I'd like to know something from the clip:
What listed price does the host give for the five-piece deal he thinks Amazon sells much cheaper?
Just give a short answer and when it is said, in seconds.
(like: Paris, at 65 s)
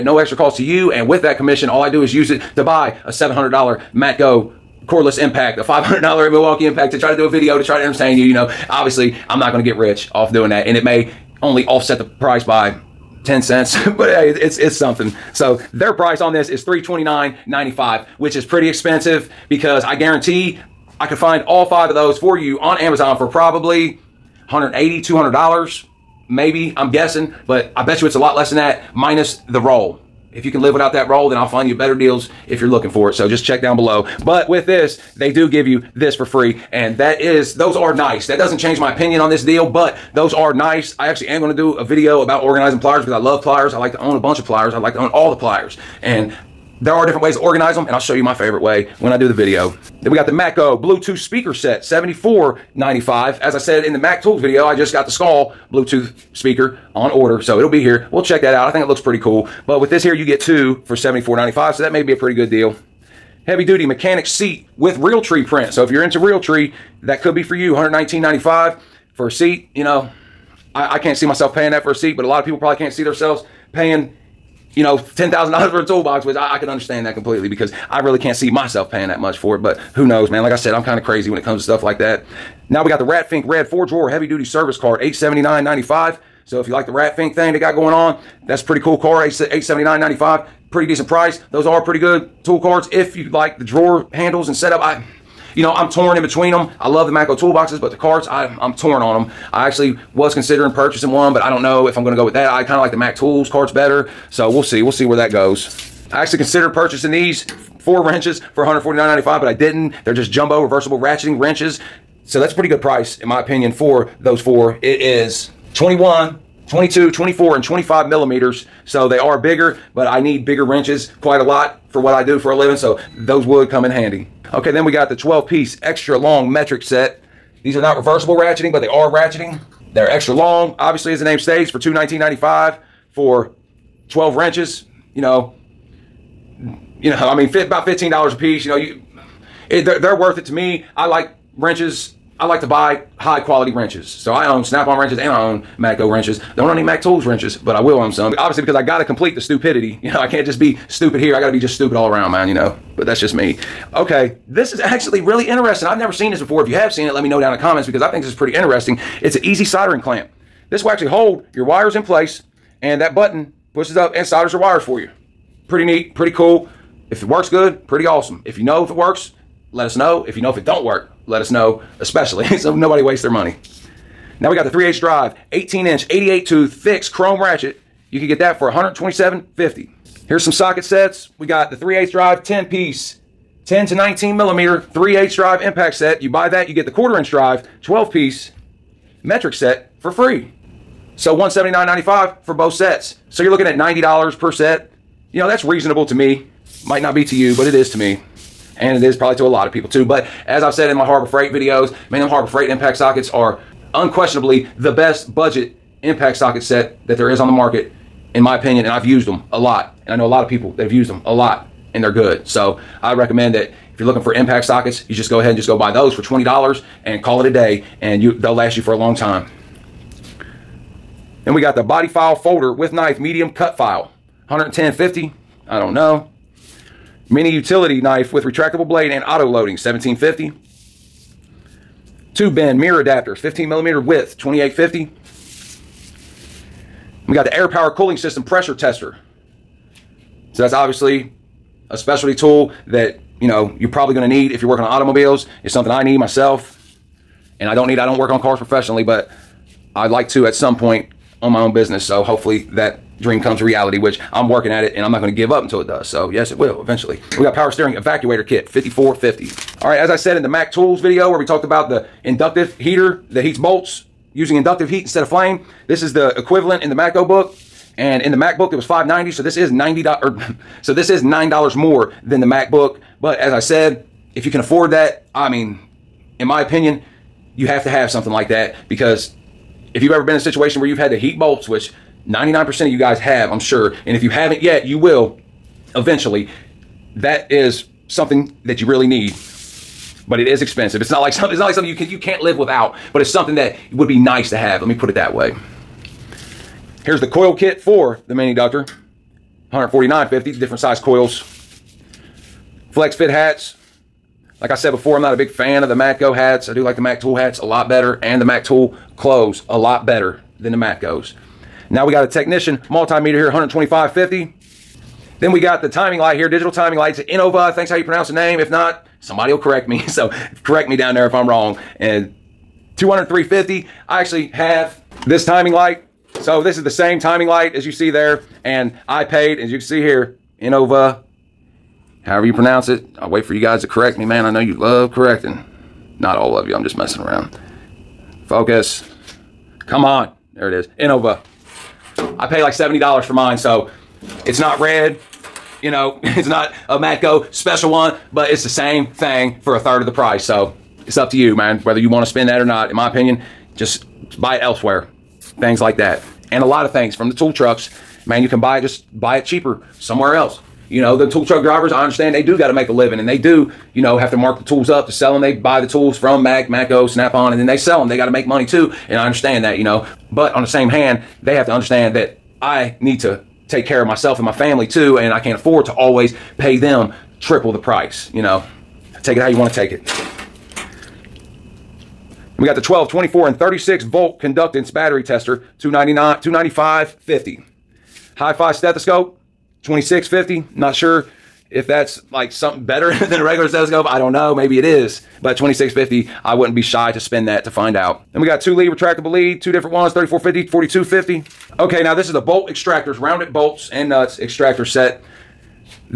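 $329.95, at 16 s.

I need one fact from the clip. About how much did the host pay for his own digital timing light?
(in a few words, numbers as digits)
$70.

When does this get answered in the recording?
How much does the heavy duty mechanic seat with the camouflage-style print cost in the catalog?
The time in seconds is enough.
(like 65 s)
67 s.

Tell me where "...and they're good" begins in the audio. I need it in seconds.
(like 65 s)
211 s.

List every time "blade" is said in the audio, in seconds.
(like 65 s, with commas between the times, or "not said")
228 s.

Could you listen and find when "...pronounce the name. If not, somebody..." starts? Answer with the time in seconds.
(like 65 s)
318 s.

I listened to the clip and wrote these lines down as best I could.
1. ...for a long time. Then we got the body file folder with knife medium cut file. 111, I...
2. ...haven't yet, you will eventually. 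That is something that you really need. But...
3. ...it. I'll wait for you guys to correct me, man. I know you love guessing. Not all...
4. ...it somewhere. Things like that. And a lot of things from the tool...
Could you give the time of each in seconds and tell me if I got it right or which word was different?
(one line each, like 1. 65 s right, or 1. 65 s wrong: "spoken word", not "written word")
1. 218 s wrong: "110", not "111"
2. 284 s right
3. 332 s wrong: "correcting", not "guessing"
4. 354 s wrong: "elsewhere", not "somewhere".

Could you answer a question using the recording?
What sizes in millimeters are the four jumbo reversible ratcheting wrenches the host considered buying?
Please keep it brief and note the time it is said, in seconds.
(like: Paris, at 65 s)
21, 22, 24, and 25, at 115 s.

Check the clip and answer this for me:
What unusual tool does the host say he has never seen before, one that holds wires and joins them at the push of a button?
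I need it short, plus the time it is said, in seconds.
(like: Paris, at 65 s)
easy soldering clamp, at 159 s.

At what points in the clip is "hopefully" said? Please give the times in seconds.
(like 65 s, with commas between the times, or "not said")
252 s.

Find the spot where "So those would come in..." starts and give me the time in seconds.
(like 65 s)
122 s.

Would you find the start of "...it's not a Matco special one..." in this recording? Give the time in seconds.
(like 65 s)
346 s.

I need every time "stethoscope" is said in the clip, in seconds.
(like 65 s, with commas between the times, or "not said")
388 s, 393 s.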